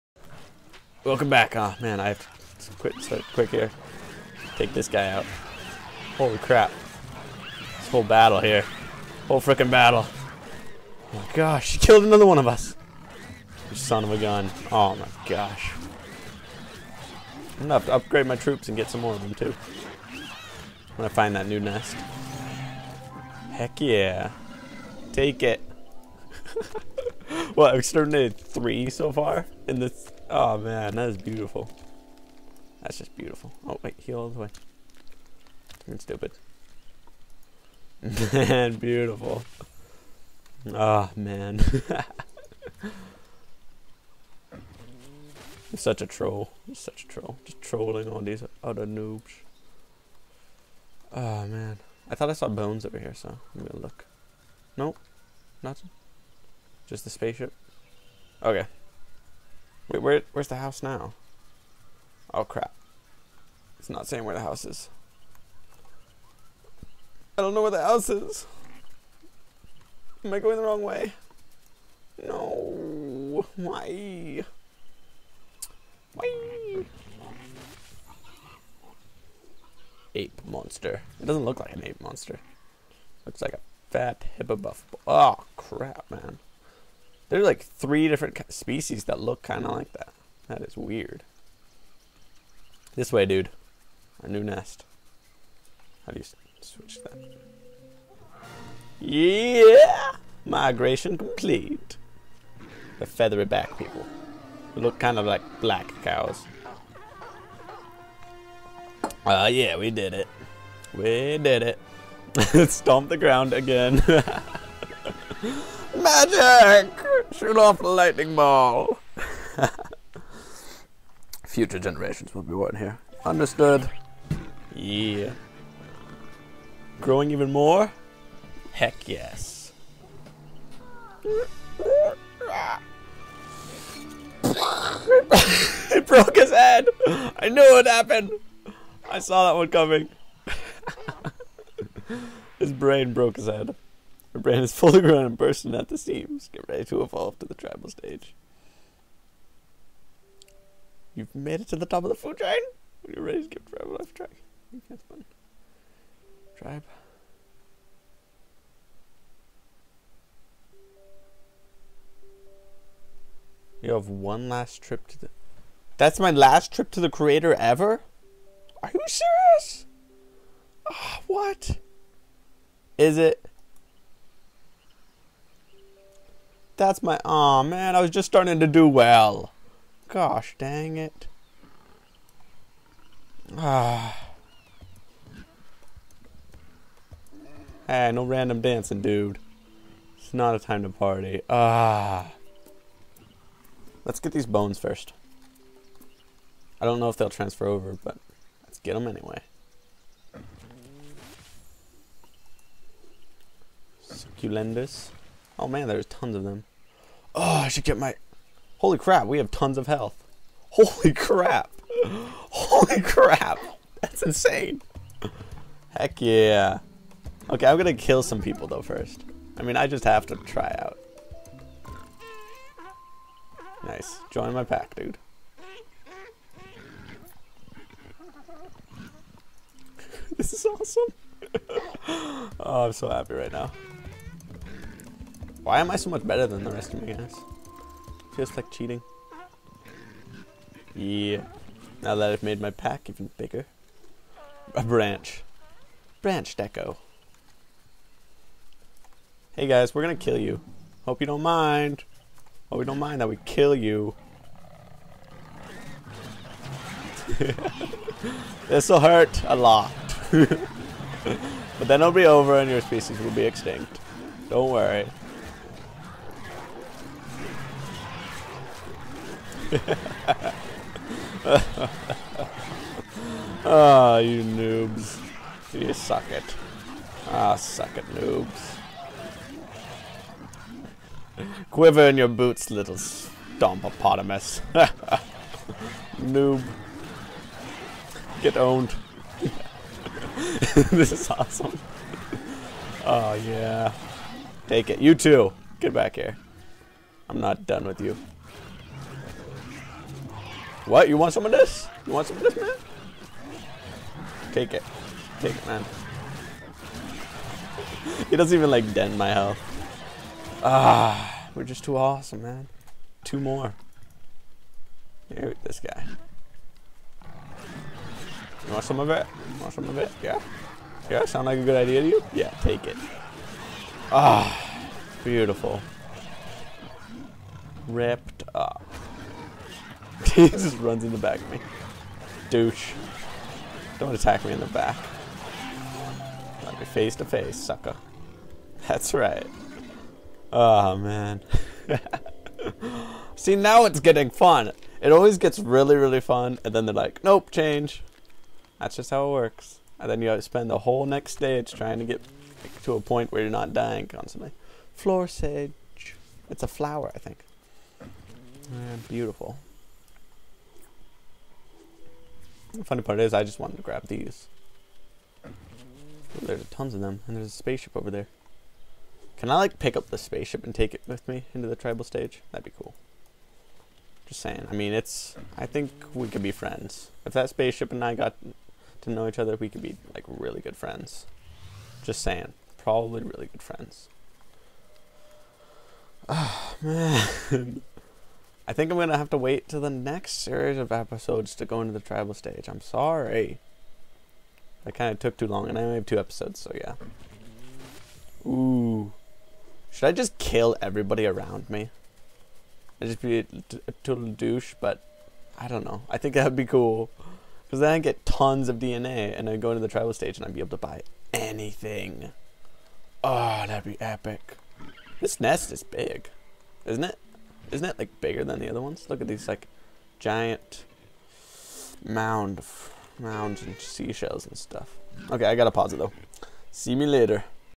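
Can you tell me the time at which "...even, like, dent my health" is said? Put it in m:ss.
5:08.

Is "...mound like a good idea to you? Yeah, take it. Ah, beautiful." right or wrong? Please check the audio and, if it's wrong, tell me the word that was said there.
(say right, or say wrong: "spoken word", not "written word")
wrong: "sound", not "mound".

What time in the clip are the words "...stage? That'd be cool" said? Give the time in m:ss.
6:12.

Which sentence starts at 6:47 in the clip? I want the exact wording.
Because then I'd get tons of DNA, and I'd go into the tribal stage, and I'd be able to buy anything.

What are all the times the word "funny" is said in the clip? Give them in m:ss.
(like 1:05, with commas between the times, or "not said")
6:02.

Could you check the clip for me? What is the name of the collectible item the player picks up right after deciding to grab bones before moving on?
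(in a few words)
Succulendus.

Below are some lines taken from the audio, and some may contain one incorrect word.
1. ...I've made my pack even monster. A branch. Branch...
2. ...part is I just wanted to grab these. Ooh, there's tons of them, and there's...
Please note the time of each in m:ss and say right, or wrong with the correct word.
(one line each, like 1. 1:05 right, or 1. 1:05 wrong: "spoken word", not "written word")
1. 4:02 wrong: "bigger", not "monster"
2. 6:03 right.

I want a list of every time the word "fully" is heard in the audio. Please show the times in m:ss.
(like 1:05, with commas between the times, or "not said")
2:24.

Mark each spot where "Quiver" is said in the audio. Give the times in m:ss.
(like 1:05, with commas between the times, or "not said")
4:41.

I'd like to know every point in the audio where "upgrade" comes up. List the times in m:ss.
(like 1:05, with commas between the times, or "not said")
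0:17.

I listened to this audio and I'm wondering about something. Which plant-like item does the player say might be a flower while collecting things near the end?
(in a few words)
Floor sage.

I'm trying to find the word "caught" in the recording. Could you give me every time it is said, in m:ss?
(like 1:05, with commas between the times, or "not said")
not said.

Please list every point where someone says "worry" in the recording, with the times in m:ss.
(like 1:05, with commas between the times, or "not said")
4:24.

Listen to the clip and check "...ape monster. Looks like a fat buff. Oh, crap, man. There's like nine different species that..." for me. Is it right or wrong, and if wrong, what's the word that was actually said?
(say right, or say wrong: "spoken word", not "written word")
wrong: "three", not "nine".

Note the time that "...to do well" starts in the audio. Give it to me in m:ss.
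2:58.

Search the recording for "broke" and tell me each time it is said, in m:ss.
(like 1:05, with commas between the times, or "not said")
2:16, 2:23.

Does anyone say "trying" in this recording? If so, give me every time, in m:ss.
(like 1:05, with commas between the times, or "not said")
5:51.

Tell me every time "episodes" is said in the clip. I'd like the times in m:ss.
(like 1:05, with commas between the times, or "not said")
6:30, 6:36.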